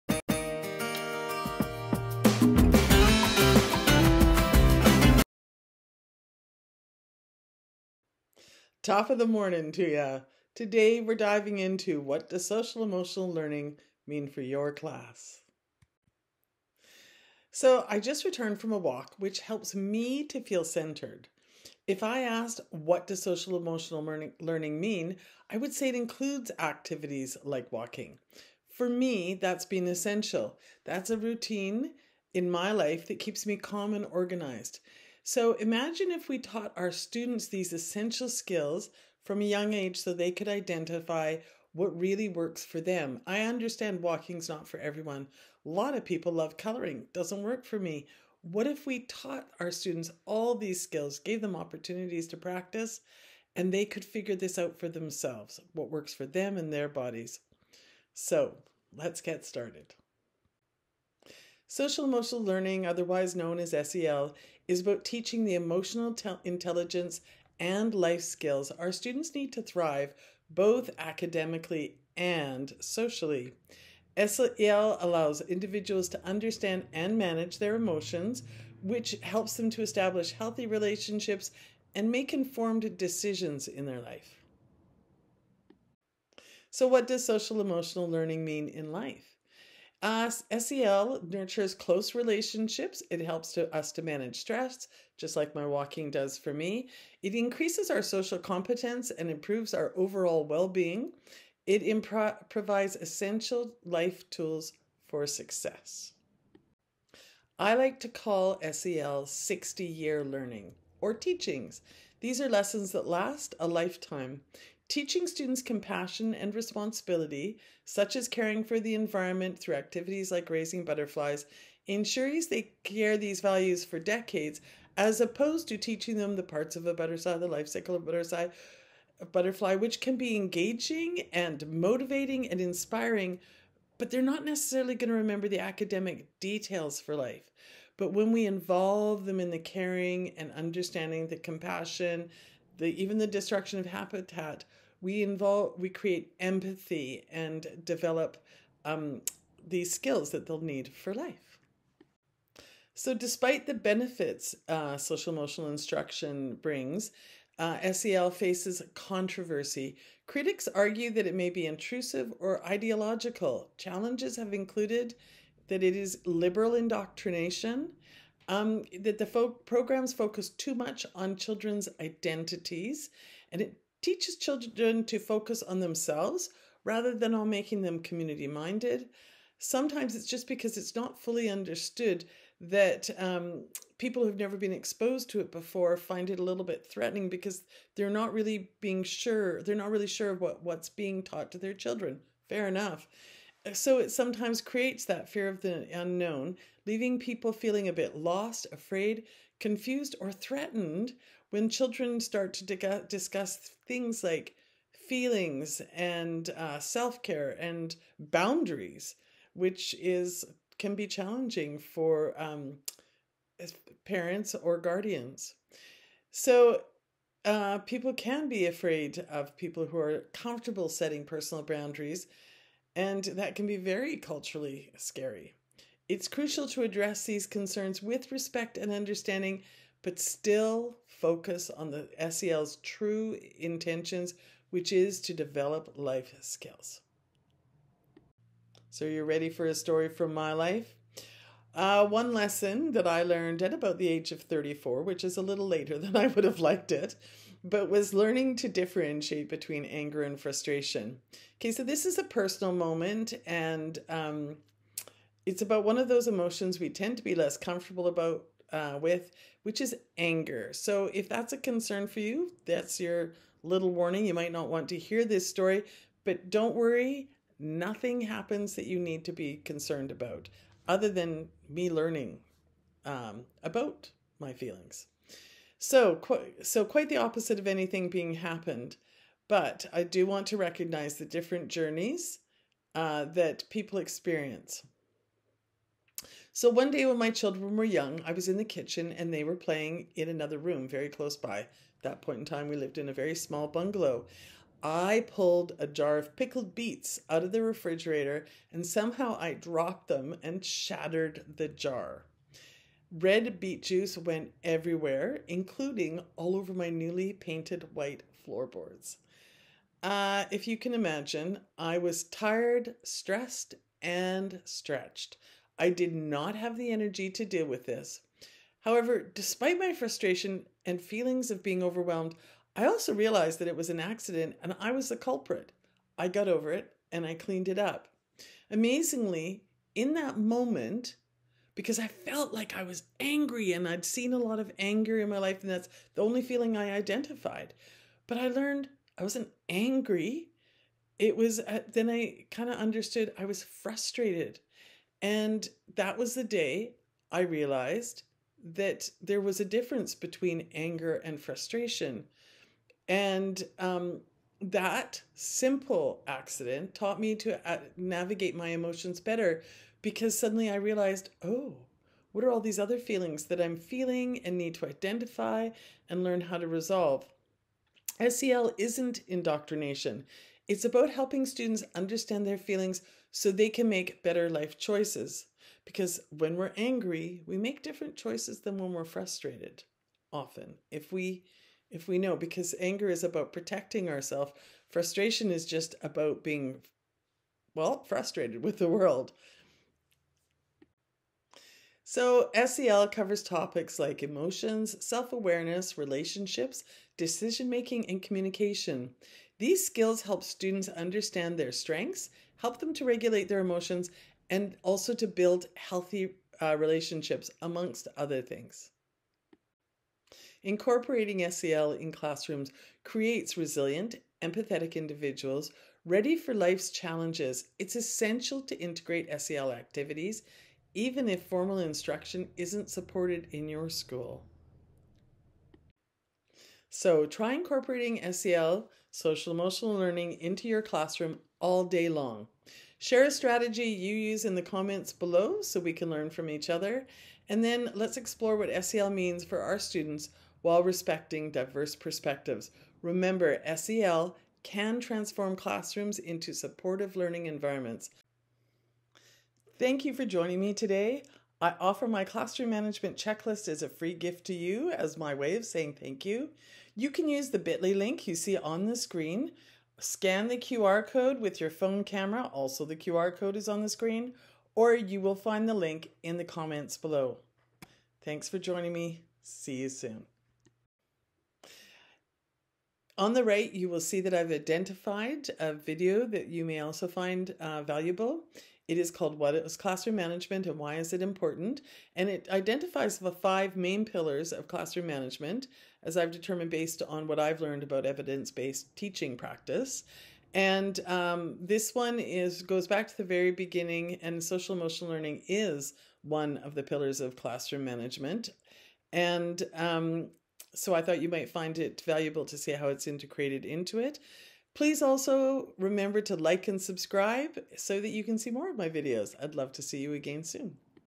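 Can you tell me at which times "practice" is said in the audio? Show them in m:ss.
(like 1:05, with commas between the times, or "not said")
0:52, 8:09.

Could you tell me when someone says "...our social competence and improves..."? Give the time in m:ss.
1:37.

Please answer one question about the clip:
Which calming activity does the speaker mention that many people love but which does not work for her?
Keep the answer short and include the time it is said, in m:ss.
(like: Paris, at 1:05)
Coloring, at 0:46.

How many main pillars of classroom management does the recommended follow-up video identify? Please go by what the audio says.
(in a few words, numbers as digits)
5.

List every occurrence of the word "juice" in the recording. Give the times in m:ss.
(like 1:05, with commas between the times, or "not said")
5:03.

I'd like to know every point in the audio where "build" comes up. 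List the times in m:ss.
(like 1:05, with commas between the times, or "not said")
6:45.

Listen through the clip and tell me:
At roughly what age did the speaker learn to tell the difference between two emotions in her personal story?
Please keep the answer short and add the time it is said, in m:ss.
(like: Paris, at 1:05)
34, at 4:04.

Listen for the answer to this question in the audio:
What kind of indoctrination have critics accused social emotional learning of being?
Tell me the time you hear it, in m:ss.
2:46.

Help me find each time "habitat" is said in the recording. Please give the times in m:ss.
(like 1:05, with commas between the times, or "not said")
2:23.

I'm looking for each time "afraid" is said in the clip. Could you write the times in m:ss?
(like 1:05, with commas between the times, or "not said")
3:18, 3:38.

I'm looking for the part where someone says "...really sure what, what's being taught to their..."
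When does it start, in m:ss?
3:09.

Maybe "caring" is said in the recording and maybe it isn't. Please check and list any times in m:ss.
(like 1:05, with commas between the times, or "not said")
1:58, 2:19.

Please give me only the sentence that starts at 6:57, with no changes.
It's essential to integrate SEL activities even if formal instruction isn't supported in your school.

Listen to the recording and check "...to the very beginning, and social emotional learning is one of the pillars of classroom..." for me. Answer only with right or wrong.
right.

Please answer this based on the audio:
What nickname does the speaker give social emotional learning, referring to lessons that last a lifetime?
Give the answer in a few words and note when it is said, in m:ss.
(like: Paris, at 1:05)
60 year learning, at 1:49.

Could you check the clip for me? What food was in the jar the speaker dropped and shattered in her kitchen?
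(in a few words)
Pickled beets.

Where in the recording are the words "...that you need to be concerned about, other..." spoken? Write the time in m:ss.
4:28.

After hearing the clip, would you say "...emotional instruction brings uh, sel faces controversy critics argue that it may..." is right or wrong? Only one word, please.
right.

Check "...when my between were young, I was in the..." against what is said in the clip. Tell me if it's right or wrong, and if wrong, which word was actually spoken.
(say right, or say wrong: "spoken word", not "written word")
wrong: "children", not "between".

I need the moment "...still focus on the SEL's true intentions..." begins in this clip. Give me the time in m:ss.
3:50.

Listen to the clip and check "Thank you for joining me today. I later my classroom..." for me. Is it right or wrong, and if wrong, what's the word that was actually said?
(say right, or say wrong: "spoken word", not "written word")
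wrong: "offer", not "later".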